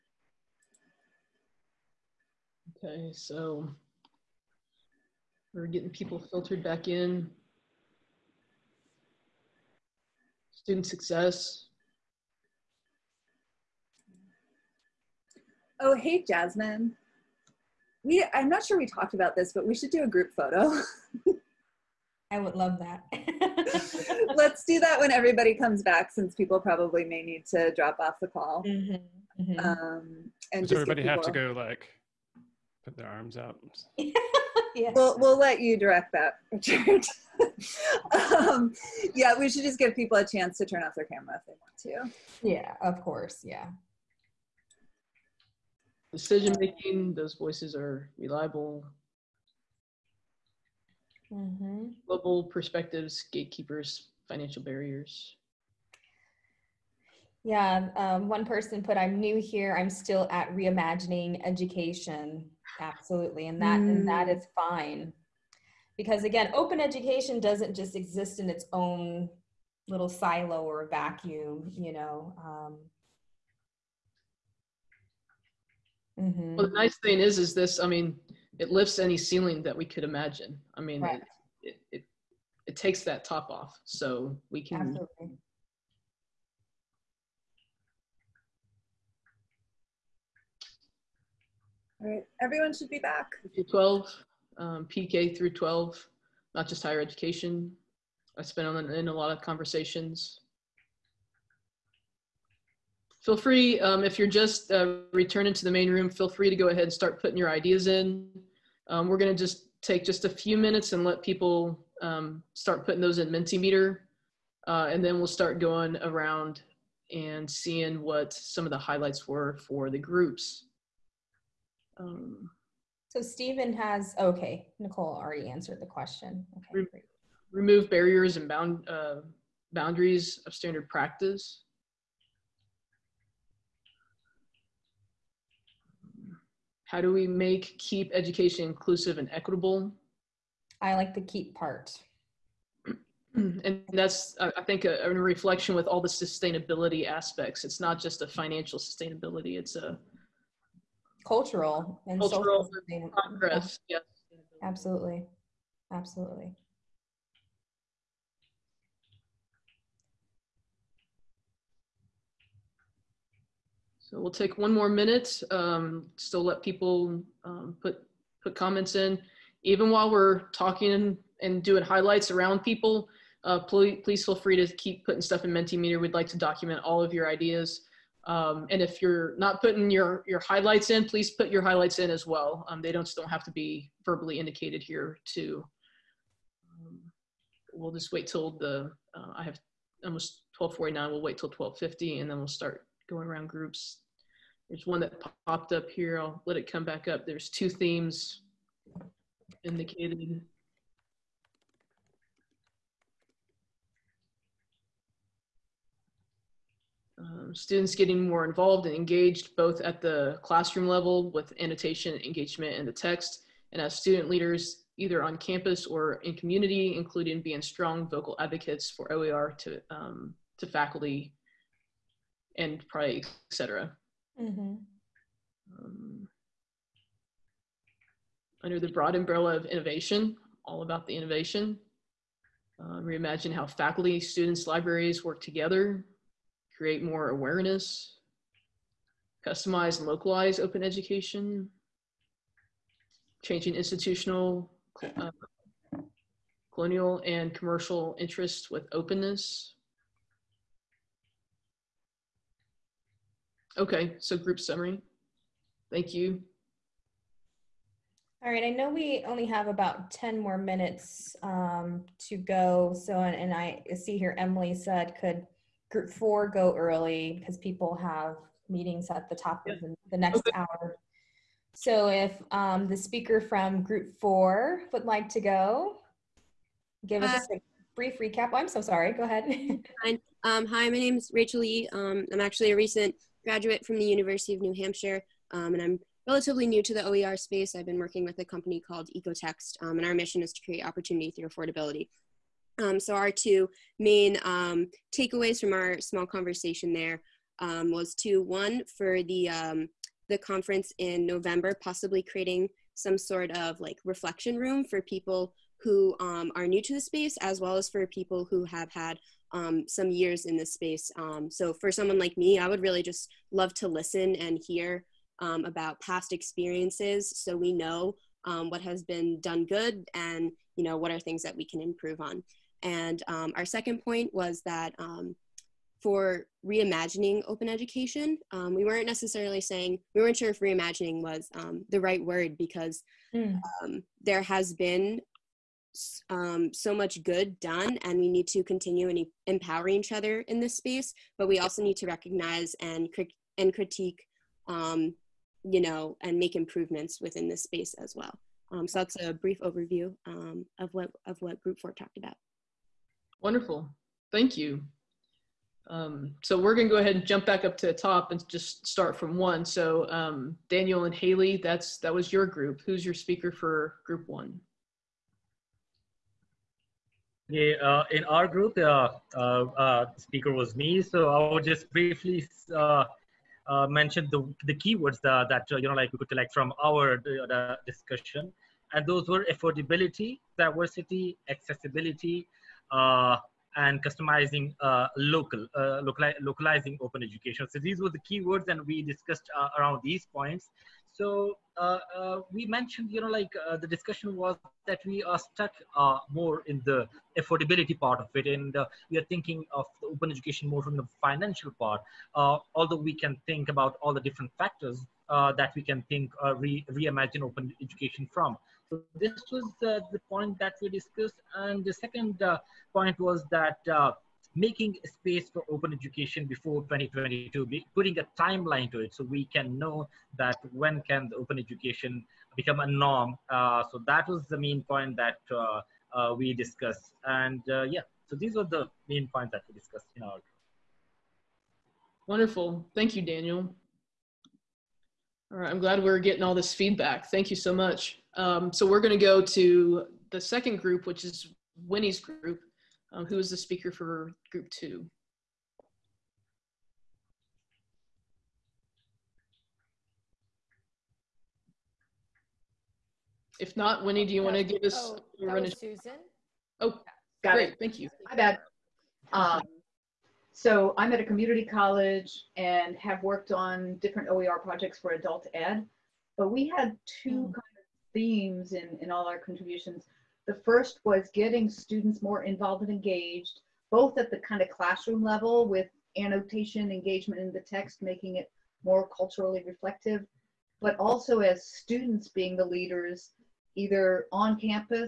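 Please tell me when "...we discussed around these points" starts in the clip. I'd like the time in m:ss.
6:28.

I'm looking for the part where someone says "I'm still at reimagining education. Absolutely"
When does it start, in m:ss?
0:59.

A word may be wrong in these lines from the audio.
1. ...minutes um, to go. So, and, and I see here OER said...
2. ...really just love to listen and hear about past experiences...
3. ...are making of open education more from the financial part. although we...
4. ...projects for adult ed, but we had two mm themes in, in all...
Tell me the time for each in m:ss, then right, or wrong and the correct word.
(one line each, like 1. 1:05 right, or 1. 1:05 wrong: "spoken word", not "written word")
1. 4:20 wrong: "Emily", not "OER"
2. 5:12 right
3. 6:39 wrong: "thinking", not "making"
4. 7:44 right.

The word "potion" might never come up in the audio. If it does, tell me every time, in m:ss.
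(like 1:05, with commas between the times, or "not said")
not said.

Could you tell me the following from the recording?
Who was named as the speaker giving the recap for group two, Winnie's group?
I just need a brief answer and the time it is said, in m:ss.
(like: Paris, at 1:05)
Susan, at 7:35.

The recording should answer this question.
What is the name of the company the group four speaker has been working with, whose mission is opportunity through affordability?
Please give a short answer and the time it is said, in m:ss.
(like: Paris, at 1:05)
Ecotext, at 4:49.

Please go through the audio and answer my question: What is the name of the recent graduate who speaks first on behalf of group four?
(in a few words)
Rachel Lee.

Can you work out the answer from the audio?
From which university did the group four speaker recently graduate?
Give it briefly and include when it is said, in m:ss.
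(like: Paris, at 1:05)
University of New Hampshire, at 4:44.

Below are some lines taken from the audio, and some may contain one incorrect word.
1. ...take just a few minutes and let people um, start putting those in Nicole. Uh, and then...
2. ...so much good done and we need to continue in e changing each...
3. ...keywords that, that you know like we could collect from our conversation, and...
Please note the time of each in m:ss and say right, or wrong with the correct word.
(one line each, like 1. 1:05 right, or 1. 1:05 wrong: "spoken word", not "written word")
1. 1:49 wrong: "Mentimeter", not "Nicole"
2. 5:36 wrong: "empowering", not "changing"
3. 6:14 wrong: "discussion", not "conversation".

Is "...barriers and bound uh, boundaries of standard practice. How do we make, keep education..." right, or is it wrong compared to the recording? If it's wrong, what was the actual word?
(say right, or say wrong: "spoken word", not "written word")
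right.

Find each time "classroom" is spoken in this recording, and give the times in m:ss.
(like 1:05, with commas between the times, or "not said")
3:30, 7:54.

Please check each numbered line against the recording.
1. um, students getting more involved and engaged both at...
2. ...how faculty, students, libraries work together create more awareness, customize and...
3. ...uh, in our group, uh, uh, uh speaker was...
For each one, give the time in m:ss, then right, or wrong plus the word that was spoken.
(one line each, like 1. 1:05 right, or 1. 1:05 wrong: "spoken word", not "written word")
1. 3:27 right
2. 3:53 right
3. 6:07 right.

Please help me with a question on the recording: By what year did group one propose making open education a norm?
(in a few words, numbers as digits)
2022.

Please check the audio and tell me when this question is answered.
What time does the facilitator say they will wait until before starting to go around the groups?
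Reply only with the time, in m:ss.
3:11.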